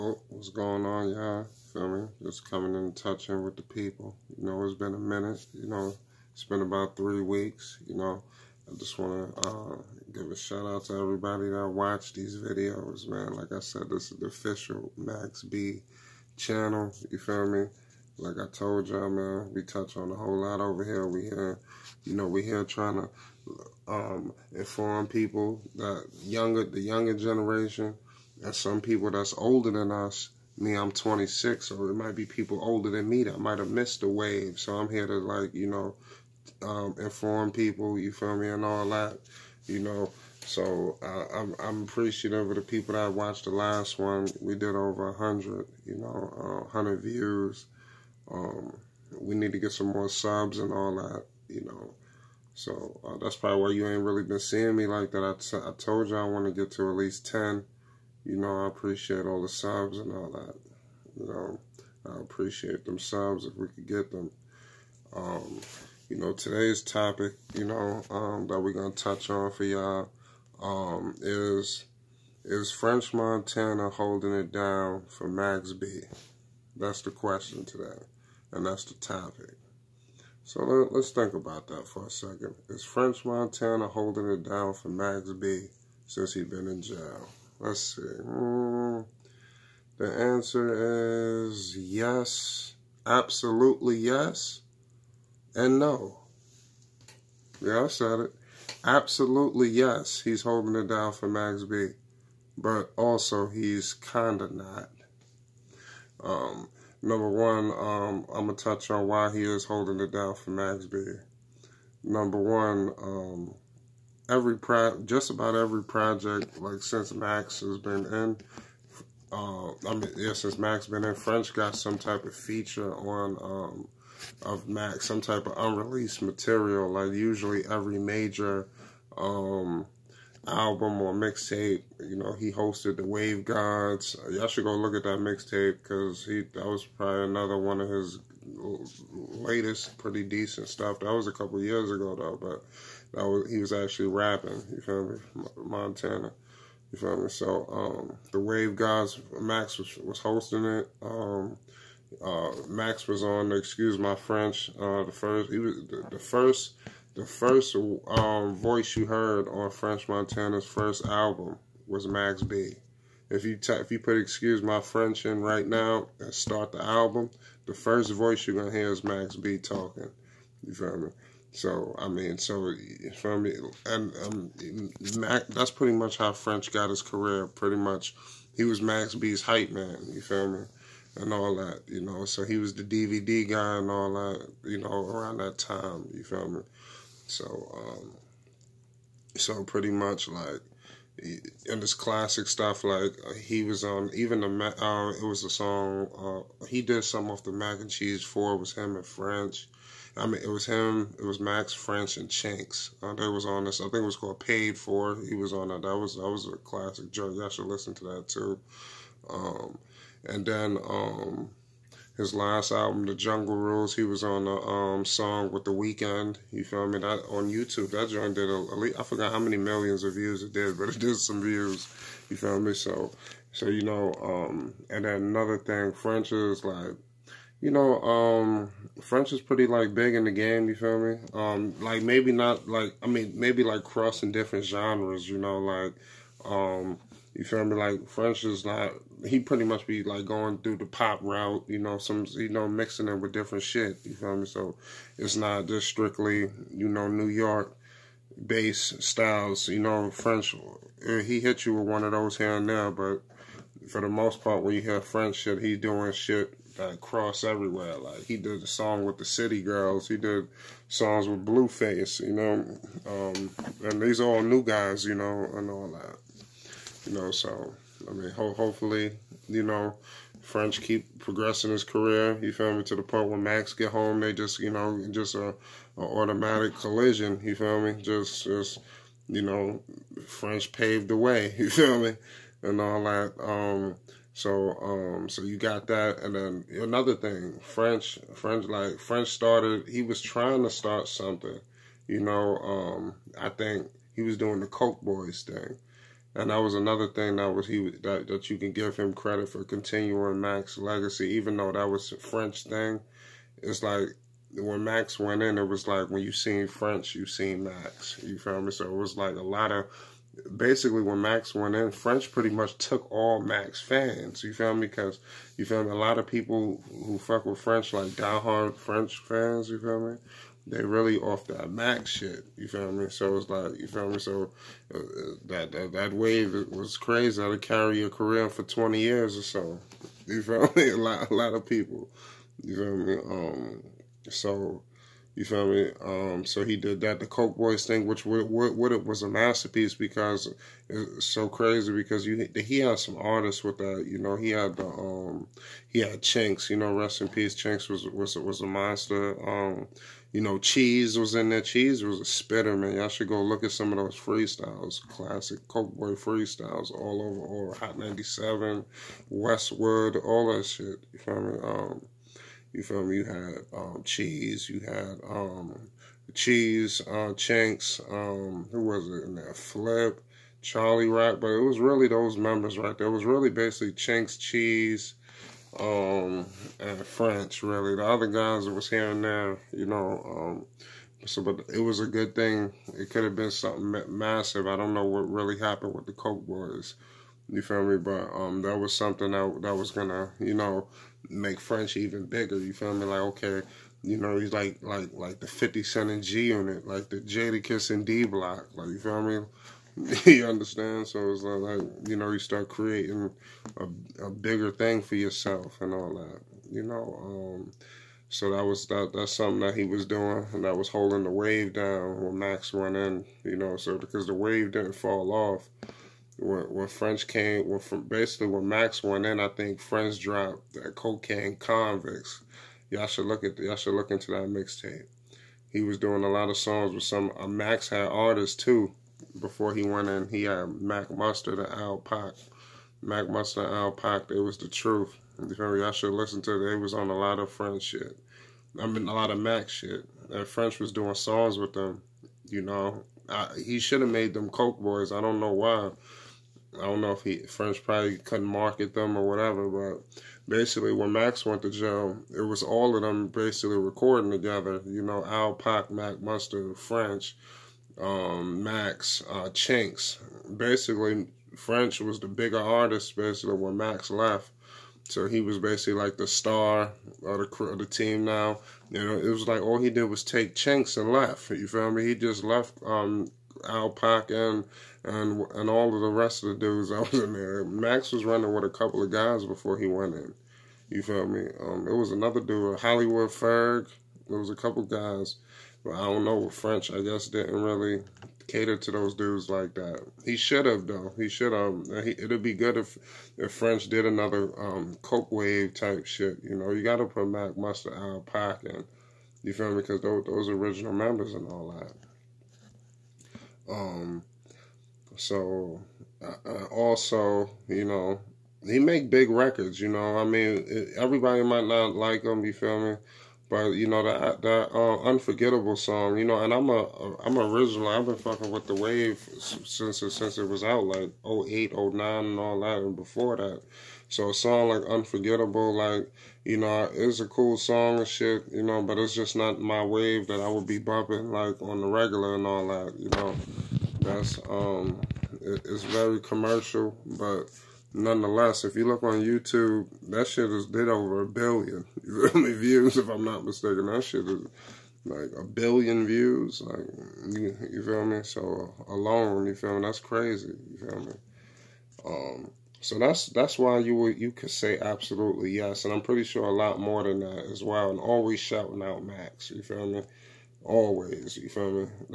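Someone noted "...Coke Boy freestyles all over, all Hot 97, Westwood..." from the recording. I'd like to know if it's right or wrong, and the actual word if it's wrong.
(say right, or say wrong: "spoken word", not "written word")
right.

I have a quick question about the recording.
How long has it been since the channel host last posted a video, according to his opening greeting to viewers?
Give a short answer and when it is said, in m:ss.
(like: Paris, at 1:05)
3 weeks, at 0:06.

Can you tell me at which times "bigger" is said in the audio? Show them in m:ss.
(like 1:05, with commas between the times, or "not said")
6:32, 6:44, 7:42.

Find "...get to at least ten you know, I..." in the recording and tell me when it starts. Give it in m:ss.
0:56.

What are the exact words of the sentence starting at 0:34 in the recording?
So I'm here to like, you know, um, inform people.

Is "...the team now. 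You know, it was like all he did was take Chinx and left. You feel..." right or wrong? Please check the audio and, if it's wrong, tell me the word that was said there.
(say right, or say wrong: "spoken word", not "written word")
right.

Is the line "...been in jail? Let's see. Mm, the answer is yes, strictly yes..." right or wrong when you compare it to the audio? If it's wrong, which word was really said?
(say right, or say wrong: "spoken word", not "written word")
wrong: "absolutely", not "strictly".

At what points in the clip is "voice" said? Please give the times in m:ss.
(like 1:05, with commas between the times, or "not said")
2:38, 2:48.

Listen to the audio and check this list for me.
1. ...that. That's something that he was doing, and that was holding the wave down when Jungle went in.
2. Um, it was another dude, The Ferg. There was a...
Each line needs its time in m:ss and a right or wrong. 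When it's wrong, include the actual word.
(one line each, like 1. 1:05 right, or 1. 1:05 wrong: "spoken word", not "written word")
1. 6:48 wrong: "Max", not "Jungle"
2. 8:01 wrong: "Hollywood", not "The".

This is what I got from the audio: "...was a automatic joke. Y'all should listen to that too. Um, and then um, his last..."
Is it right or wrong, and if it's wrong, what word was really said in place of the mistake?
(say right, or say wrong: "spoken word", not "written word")
wrong: "classic", not "automatic".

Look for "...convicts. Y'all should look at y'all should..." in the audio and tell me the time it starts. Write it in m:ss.
7:01.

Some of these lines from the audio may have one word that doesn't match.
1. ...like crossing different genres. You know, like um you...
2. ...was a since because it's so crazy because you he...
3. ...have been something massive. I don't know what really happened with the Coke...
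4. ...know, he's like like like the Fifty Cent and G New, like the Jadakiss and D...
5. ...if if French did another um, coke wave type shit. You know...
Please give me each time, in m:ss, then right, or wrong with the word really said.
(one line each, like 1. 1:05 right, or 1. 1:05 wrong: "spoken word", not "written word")
1. 3:53 right
2. 5:39 wrong: "masterpiece", not "since"
3. 6:23 right
4. 6:34 wrong: "Unit", not "New"
5. 8:12 right.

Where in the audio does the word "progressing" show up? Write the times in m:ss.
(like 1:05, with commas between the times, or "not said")
4:31.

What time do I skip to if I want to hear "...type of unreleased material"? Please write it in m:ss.
2:05.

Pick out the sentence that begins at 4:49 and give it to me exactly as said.
He was trying to start something.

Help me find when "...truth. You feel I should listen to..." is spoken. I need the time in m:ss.
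7:14.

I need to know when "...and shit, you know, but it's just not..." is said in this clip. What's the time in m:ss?
8:47.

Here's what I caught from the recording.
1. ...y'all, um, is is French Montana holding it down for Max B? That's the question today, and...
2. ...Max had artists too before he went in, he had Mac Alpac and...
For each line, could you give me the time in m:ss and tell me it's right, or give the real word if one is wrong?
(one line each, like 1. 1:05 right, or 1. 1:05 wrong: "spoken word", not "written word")
1. 1:09 right
2. 7:07 wrong: "Mustard", not "Alpac".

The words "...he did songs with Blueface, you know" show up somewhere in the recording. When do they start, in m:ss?
4:20.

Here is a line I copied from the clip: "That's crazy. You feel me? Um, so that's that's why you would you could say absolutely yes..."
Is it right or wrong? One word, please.
right.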